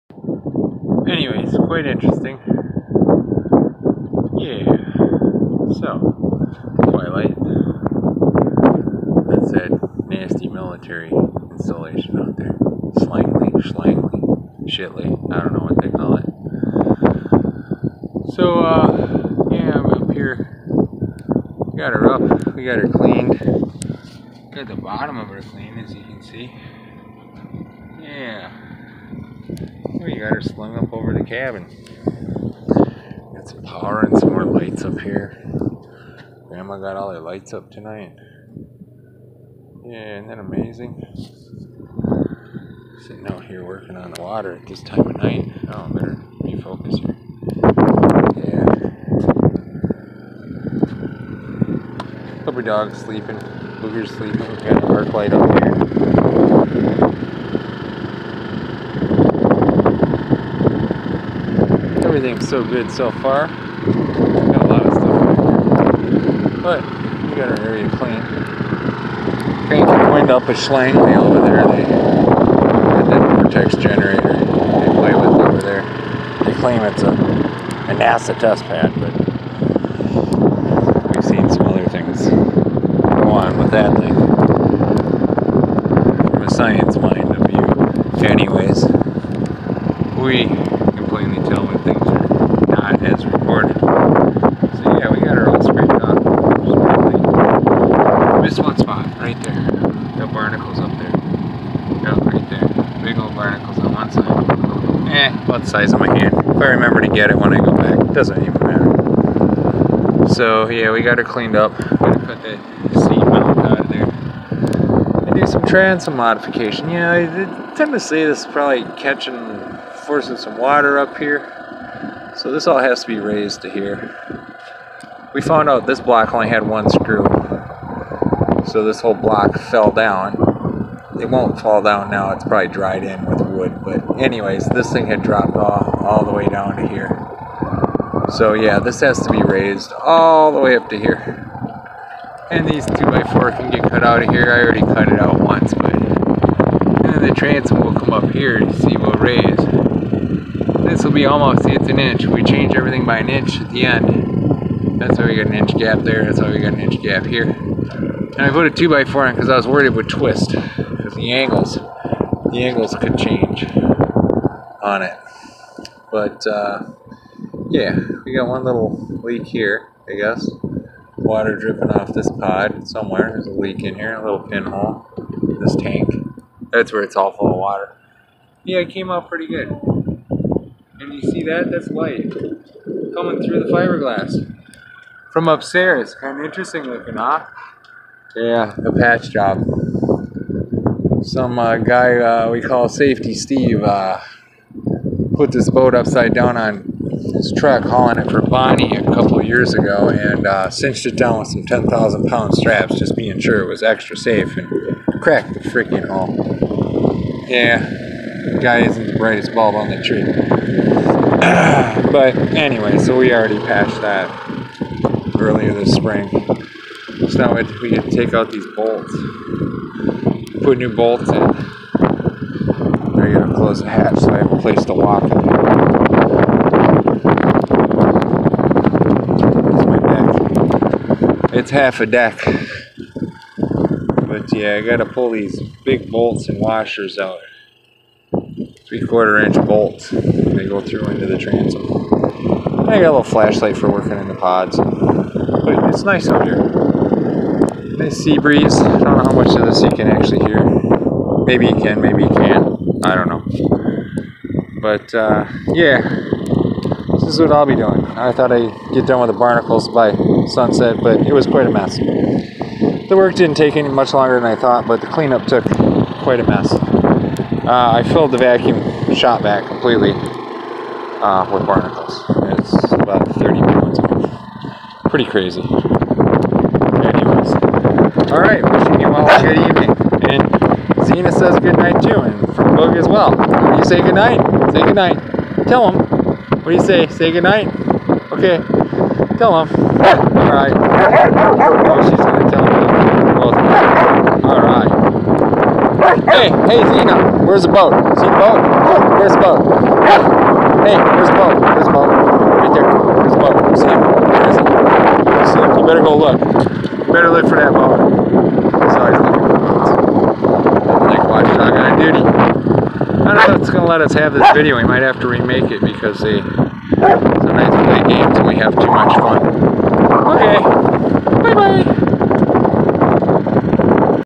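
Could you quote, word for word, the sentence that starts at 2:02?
So this all has to be raised to here.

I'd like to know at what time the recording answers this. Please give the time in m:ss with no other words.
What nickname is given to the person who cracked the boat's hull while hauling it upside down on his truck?
3:12.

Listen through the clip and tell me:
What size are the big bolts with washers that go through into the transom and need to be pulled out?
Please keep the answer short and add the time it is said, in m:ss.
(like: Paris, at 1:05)
Three quarter inch, at 3:58.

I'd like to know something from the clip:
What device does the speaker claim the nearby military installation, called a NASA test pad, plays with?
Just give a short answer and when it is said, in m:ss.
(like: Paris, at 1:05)
vortex generator, at 1:13.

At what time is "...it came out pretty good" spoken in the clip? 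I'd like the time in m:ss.
2:58.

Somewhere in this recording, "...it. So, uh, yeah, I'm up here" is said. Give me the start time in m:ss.
0:16.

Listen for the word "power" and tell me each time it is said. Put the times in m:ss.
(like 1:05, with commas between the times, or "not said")
0:33.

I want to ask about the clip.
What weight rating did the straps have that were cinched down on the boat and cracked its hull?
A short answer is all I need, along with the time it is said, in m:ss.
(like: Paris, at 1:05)
10,000 pound, at 3:21.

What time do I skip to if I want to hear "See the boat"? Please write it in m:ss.
4:58.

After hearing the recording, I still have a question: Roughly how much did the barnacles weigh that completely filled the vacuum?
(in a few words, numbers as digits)
30 pounds.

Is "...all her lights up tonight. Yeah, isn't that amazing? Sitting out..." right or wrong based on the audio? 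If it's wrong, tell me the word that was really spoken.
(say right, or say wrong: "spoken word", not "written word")
right.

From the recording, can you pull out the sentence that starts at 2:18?
So yeah, this has to be raised all the way up to here.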